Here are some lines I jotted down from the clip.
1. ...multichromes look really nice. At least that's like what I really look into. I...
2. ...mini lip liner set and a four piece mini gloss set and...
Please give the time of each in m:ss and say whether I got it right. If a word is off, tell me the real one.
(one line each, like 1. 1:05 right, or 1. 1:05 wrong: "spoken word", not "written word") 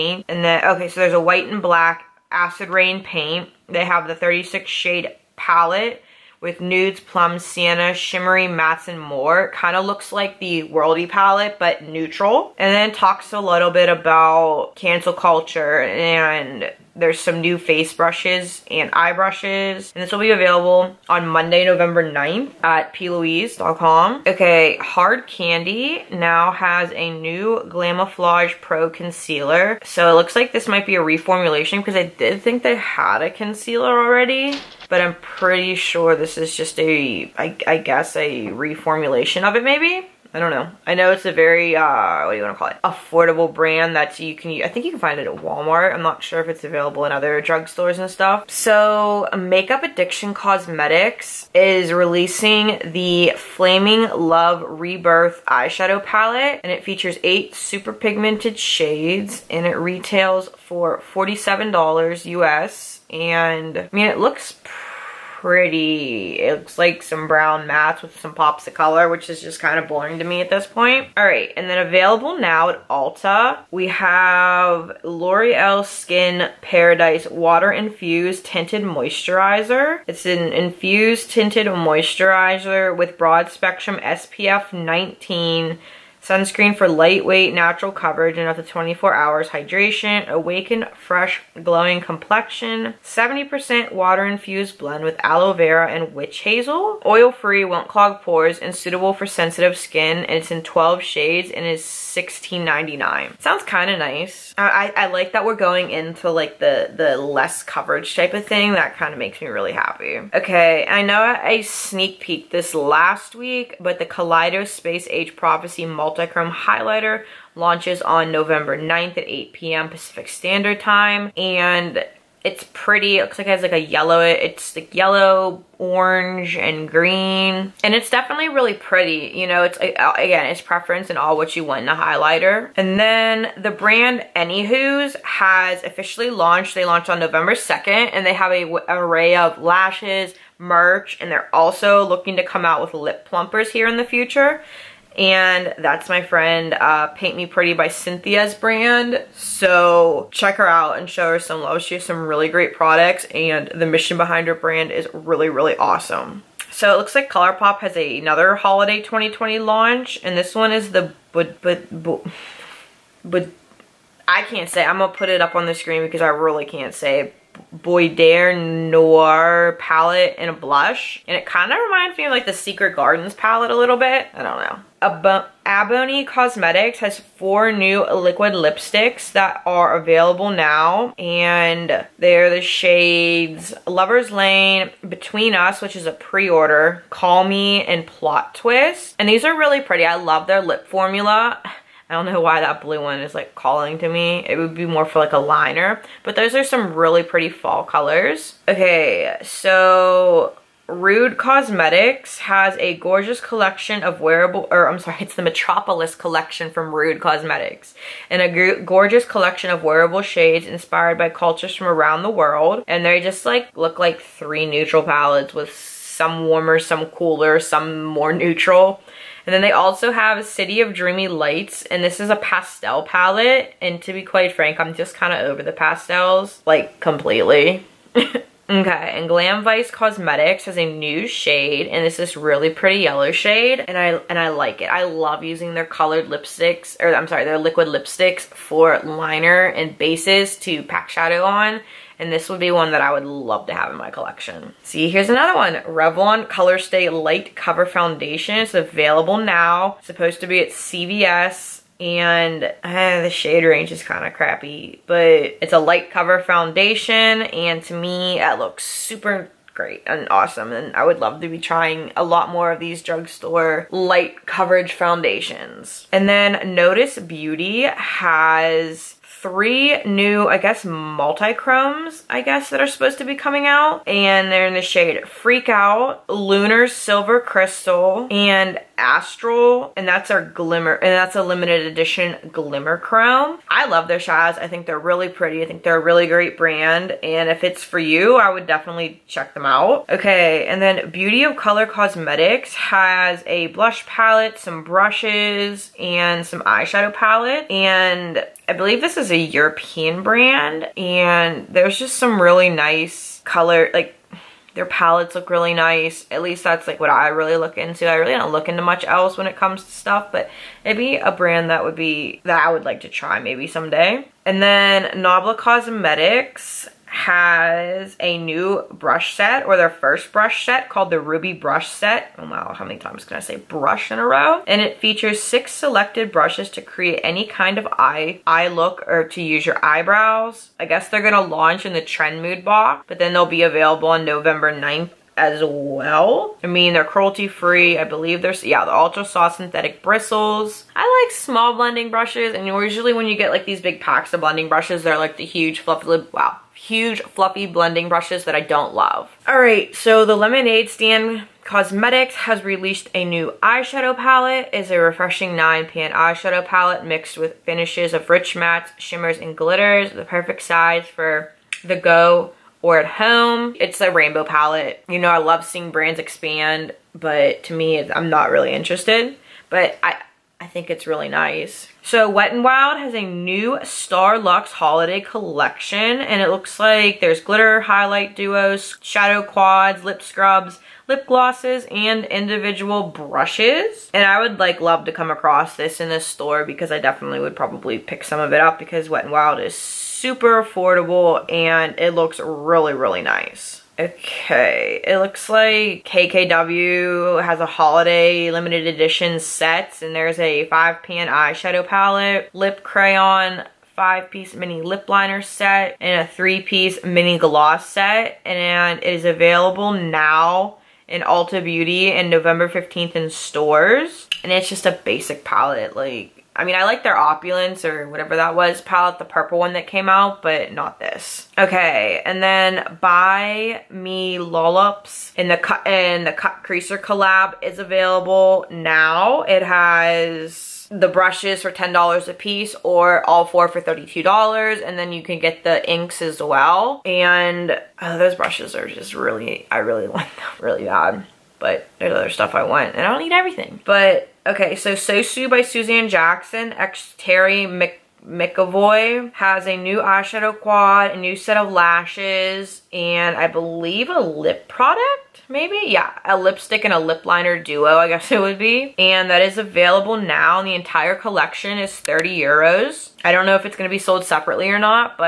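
1. 5:04 wrong: "palettes", not "multichromes"
2. 6:44 wrong: "three", not "four".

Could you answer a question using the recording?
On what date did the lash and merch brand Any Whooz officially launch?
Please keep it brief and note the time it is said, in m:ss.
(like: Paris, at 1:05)
November 2nd, at 2:17.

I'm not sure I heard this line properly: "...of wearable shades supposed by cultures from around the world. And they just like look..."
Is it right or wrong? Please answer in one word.
wrong.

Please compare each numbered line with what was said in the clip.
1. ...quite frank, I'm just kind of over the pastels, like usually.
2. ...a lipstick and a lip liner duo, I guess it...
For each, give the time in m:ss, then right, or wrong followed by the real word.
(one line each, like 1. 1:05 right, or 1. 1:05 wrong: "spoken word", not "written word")
1. 3:44 wrong: "completely", not "usually"
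2. 7:36 right.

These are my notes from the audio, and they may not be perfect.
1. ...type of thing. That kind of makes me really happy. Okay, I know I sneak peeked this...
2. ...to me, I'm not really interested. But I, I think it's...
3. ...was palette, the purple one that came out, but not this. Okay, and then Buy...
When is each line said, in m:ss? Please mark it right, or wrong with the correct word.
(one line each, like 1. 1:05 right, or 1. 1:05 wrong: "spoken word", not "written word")
1. 1:48 right
2. 6:07 right
3. 6:58 right.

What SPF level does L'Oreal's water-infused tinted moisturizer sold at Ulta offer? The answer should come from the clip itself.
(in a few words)
SPF 19.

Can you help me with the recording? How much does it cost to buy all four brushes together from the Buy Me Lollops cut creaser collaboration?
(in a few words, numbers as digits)
$32.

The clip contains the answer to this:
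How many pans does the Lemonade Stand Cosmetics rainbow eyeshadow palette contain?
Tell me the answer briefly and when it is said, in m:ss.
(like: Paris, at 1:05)
9, at 5:55.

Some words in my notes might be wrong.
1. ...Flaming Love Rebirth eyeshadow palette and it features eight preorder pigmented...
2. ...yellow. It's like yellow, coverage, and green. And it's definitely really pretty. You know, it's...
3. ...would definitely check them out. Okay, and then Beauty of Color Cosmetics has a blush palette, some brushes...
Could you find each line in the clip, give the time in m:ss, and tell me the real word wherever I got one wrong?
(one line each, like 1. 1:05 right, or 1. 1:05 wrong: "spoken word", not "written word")
1. 0:53 wrong: "super", not "preorder"
2. 2:03 wrong: "orange", not "coverage"
3. 4:48 right.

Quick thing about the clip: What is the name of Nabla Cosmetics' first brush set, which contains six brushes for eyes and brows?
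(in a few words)
Ruby Brush Set.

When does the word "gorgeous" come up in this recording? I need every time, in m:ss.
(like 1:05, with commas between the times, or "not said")
3:22, 3:28.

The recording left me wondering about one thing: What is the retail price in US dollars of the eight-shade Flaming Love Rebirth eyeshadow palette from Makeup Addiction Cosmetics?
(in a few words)
$47.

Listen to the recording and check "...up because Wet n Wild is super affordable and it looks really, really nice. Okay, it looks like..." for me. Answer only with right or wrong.
right.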